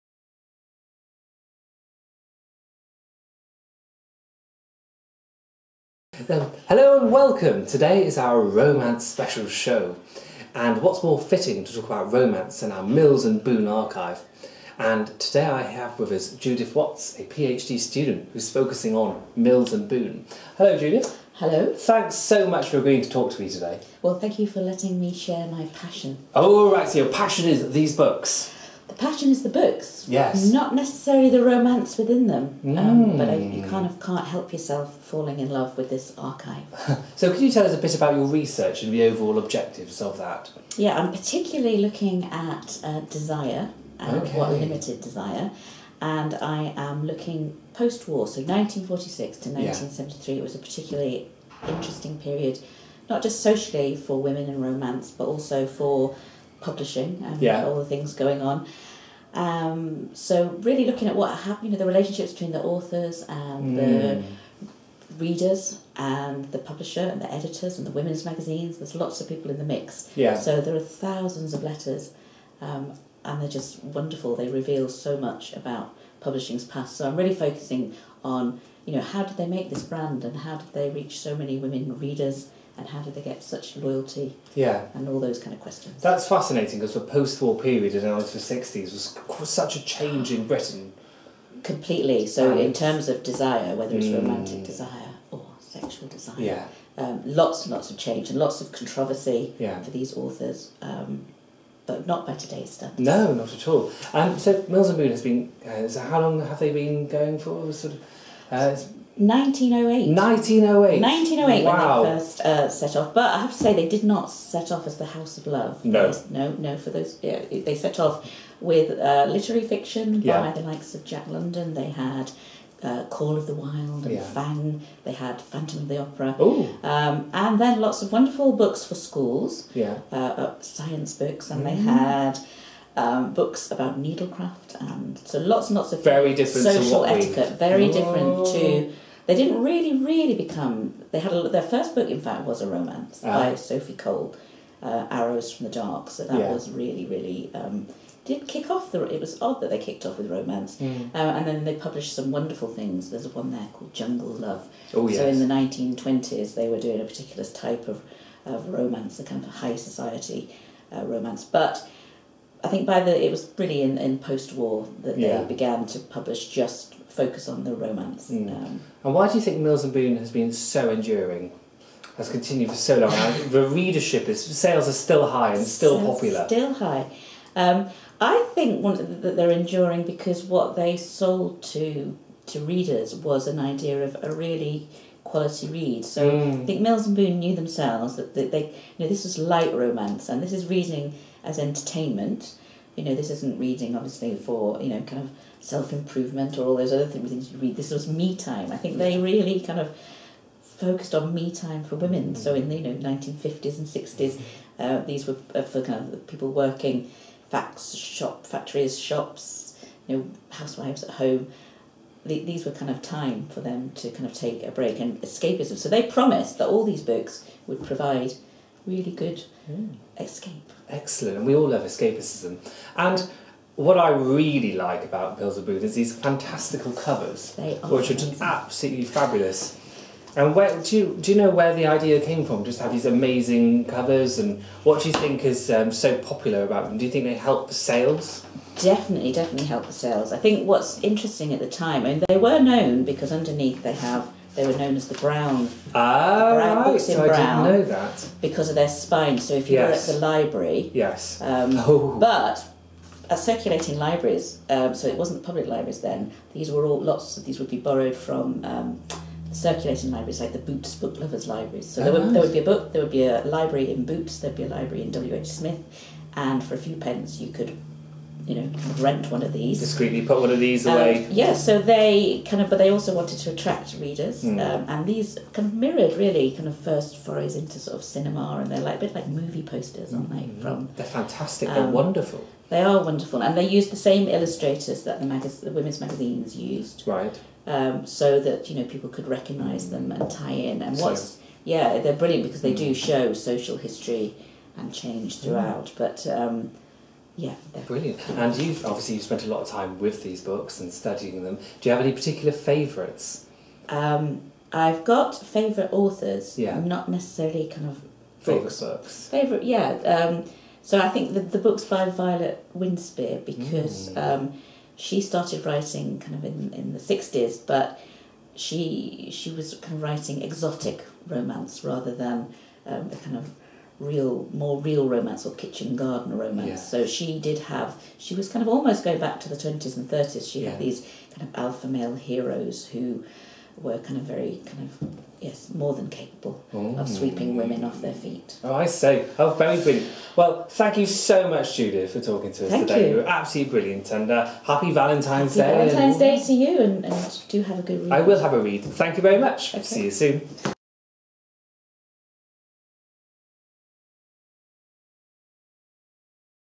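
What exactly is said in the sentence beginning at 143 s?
by Sophie Cole, uh, Arrows from the Dark.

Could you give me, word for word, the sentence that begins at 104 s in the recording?
Um, so Mills and Boon has been.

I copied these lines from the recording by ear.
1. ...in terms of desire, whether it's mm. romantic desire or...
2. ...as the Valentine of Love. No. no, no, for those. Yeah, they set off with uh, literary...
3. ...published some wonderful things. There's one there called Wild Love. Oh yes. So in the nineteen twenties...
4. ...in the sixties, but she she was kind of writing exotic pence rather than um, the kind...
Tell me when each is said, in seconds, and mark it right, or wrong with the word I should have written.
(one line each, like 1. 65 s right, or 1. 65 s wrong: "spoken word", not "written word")
1. 92 s right
2. 114 s wrong: "House", not "Valentine"
3. 151 s wrong: "Jungle", not "Wild"
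4. 316 s wrong: "romance", not "pence".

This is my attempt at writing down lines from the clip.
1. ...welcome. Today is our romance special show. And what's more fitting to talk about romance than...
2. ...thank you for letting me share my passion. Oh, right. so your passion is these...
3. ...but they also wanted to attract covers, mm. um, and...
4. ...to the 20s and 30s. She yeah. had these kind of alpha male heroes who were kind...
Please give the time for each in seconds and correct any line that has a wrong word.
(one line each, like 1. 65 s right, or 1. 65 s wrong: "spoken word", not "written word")
1. 7 s right
2. 24 s right
3. 272 s wrong: "readers", not "covers"
4. 329 s right.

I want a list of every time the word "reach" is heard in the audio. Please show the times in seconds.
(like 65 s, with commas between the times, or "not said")
80 s.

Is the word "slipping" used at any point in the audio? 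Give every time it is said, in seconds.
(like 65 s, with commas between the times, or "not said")
not said.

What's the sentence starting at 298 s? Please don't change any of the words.
And you've obviously you've spent a lot of time with these books and studying them.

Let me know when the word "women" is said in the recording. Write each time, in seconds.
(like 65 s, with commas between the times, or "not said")
54 s, 67 s, 81 s, 201 s, 285 s, 337 s.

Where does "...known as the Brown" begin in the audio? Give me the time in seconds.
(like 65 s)
244 s.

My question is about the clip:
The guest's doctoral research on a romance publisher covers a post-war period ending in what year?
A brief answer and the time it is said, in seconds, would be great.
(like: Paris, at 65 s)
1973, at 49 s.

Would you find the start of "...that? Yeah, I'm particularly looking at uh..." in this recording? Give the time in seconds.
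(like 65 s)
40 s.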